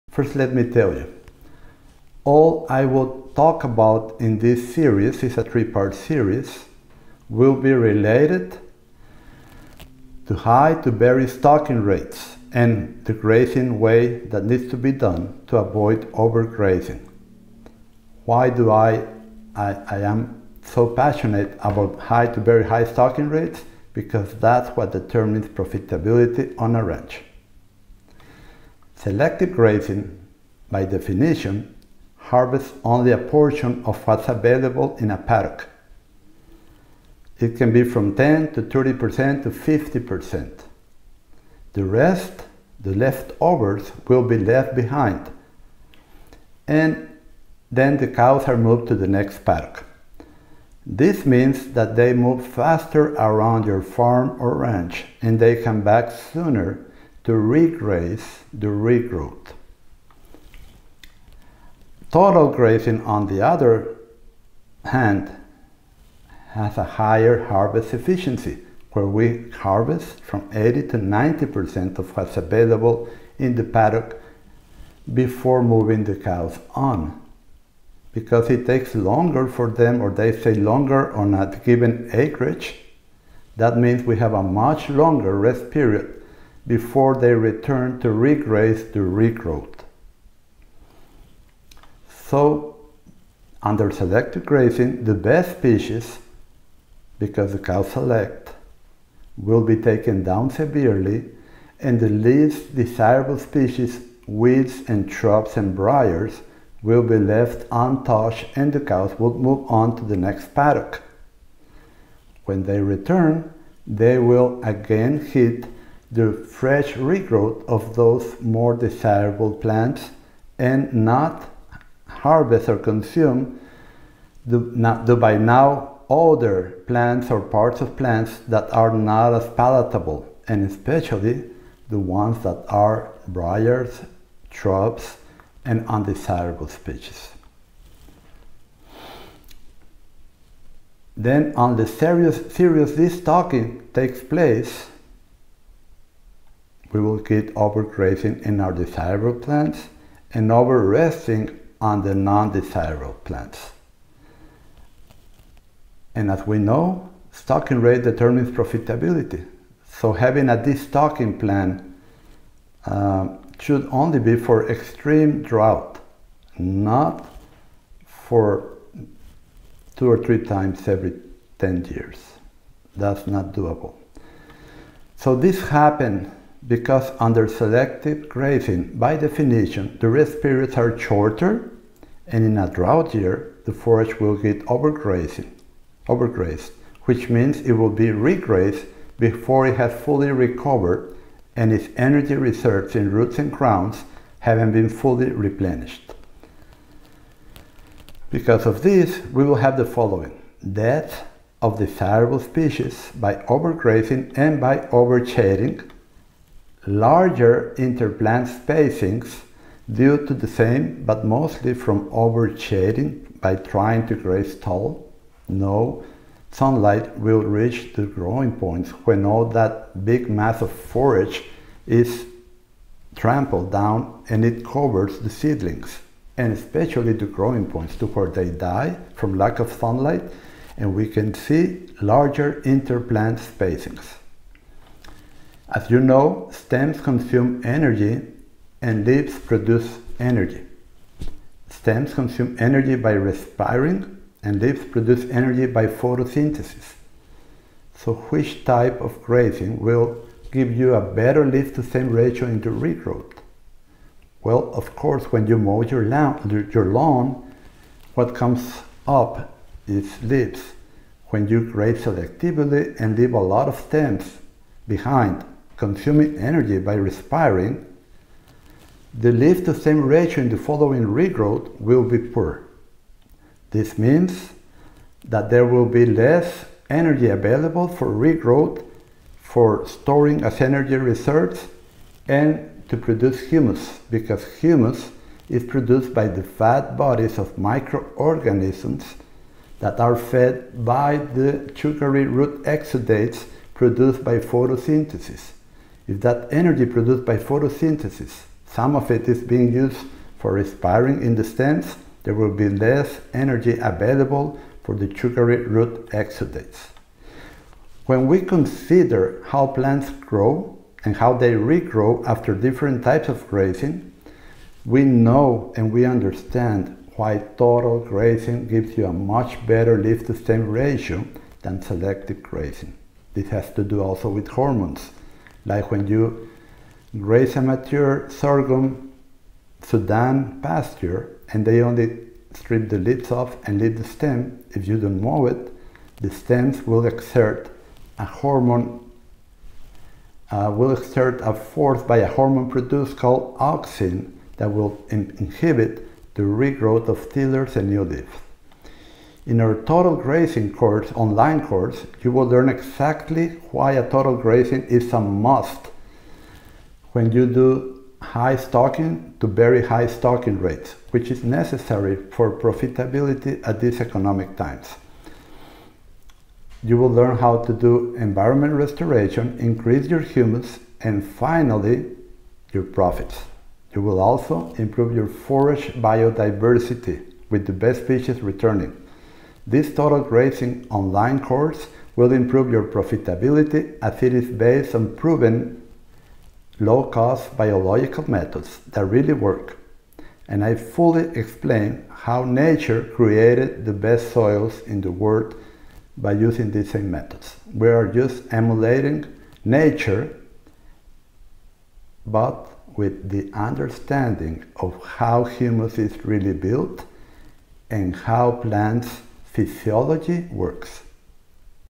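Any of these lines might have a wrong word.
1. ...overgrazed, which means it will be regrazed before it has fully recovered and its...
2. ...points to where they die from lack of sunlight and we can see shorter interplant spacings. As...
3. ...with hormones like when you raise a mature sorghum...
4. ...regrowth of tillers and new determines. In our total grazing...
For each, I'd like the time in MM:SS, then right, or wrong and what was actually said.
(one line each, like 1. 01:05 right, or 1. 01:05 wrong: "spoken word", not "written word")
1. 03:06 right
2. 03:47 wrong: "larger", not "shorter"
3. 05:24 right
4. 05:46 wrong: "leaves", not "determines".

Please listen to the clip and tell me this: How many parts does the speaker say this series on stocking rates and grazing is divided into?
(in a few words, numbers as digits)
3.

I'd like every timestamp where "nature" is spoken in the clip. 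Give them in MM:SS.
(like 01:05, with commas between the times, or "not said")
06:32, 06:39.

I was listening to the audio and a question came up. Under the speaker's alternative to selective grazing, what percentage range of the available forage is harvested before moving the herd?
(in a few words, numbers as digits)
80 to 90%.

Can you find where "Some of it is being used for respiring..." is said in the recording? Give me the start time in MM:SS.
04:58.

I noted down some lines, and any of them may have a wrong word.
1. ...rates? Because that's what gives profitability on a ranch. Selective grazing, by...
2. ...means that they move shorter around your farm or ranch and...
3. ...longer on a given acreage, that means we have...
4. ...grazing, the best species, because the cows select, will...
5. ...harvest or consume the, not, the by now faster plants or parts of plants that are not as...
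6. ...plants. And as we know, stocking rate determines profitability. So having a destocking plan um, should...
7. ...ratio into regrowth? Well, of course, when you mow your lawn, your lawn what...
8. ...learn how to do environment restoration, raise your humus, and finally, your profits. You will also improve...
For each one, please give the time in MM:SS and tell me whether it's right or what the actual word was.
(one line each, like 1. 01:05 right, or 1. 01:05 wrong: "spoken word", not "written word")
1. 00:23 wrong: "determines", not "gives"
2. 00:51 wrong: "faster", not "shorter"
3. 01:20 right
4. 01:34 right
5. 02:02 wrong: "older", not "faster"
6. 02:33 right
7. 04:12 right
8. 06:07 wrong: "increase", not "raise".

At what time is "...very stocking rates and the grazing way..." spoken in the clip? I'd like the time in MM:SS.
00:10.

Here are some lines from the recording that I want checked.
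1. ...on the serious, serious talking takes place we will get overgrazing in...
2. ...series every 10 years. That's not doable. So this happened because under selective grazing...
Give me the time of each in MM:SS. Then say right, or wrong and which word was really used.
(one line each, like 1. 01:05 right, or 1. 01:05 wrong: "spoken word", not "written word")
1. 02:21 right
2. 02:50 wrong: "times", not "series".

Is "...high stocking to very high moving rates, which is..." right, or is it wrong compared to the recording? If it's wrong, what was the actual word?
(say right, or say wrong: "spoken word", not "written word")
wrong: "stocking", not "moving".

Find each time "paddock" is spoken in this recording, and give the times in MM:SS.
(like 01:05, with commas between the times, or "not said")
00:35, 00:49, 01:13, 01:50.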